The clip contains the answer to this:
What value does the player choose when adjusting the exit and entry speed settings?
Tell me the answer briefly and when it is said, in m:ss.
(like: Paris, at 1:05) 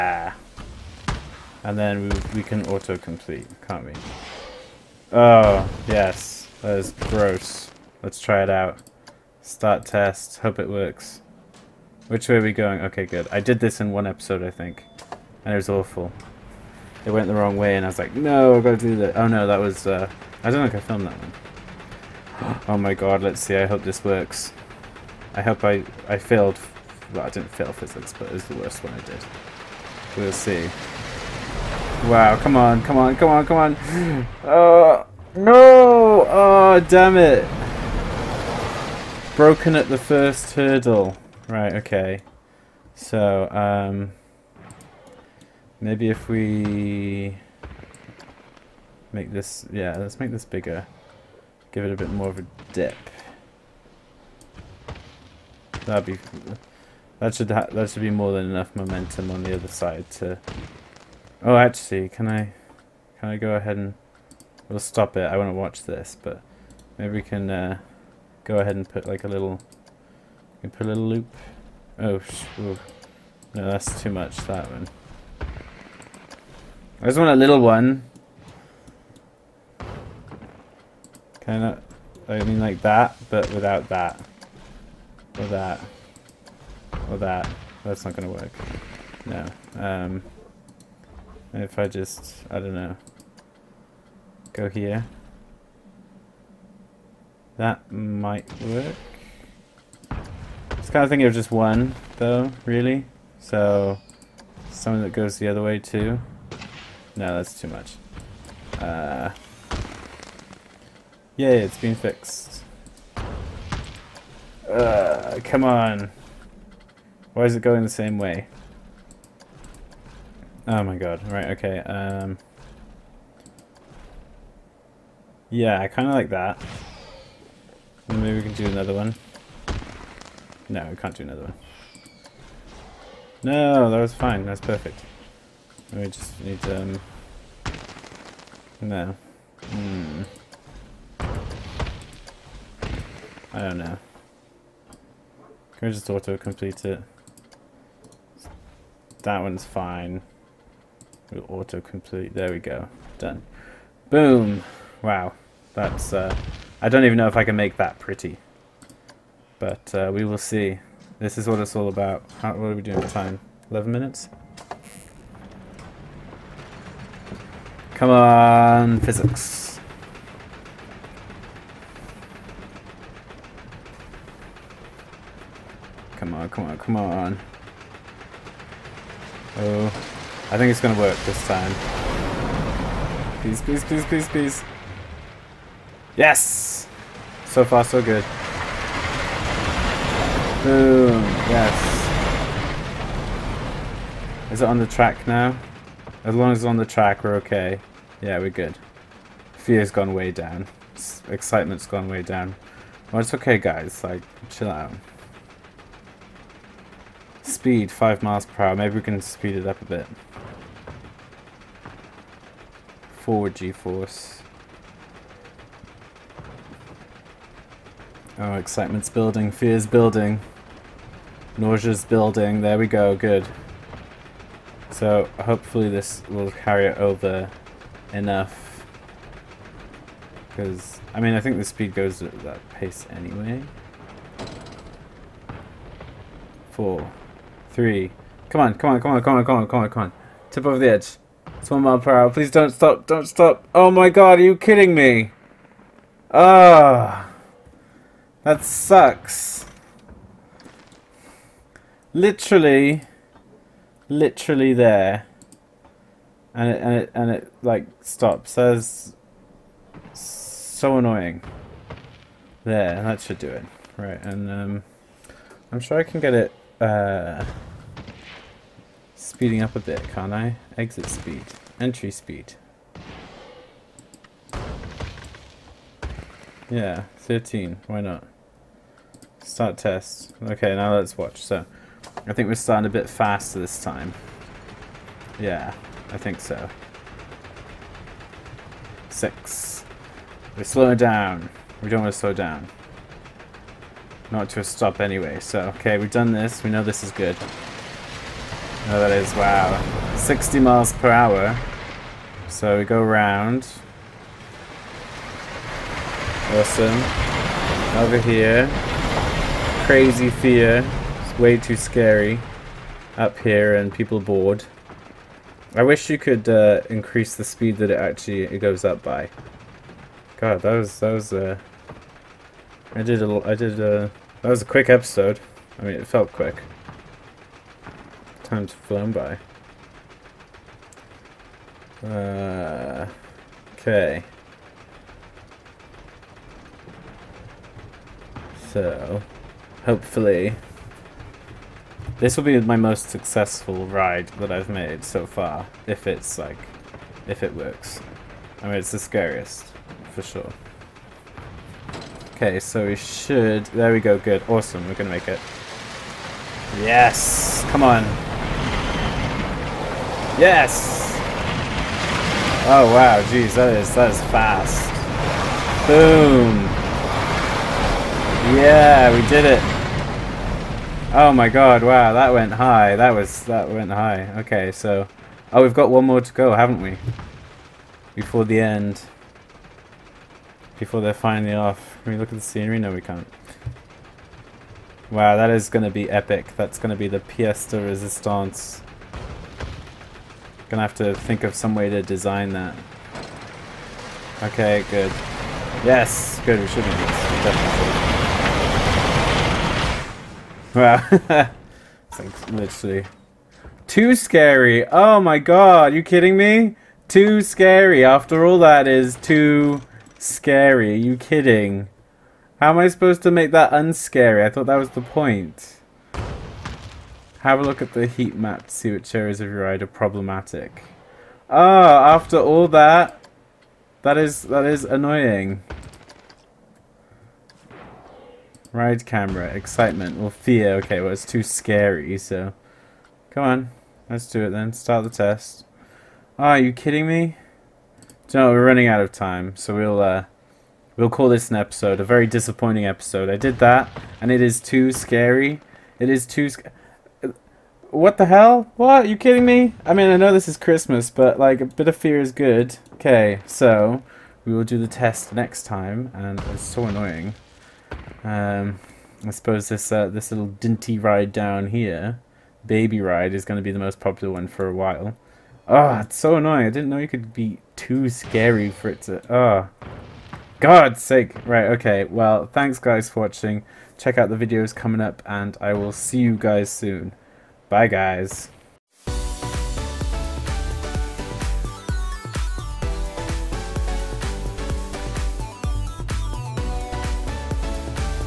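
13, at 4:37.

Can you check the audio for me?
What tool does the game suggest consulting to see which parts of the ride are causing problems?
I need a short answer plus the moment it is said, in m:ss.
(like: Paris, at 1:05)
heat map, at 6:58.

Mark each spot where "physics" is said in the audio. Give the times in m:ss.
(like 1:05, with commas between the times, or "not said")
0:27, 2:49.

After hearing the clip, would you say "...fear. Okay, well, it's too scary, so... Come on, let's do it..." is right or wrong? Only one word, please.
right.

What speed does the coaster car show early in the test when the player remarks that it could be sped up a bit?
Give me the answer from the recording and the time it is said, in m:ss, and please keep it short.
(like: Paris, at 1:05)
5 miles per hour, at 3:27.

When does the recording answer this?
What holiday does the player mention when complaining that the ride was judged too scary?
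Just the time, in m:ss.
7:30.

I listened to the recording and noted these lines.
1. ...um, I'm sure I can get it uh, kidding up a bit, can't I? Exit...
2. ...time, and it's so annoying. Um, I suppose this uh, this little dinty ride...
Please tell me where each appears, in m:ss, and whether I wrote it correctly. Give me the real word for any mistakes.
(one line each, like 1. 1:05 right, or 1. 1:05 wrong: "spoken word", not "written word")
1. 4:24 wrong: "speeding", not "kidding"
2. 7:35 right.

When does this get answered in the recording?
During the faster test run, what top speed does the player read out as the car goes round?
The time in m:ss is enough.
5:00.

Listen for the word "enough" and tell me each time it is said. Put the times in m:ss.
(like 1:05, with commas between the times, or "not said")
0:58, 3:48.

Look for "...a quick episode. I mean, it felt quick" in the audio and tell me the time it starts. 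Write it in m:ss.
5:24.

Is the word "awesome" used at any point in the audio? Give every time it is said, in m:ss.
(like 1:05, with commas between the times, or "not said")
5:06, 5:54.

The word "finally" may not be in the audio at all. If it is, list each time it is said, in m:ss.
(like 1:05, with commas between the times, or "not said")
6:21.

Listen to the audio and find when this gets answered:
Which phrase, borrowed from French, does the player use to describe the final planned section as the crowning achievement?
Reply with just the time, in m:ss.
6:27.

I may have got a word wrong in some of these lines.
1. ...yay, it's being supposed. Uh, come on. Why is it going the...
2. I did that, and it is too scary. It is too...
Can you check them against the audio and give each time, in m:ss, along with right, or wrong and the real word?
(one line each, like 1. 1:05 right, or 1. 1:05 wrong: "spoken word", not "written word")
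1. 1:51 wrong: "fixed", not "supposed"
2. 7:23 right.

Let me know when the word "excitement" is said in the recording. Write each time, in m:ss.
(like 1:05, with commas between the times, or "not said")
3:21, 3:38, 7:09.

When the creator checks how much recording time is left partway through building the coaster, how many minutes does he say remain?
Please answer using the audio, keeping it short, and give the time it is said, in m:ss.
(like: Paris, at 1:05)
11 minutes, at 2:43.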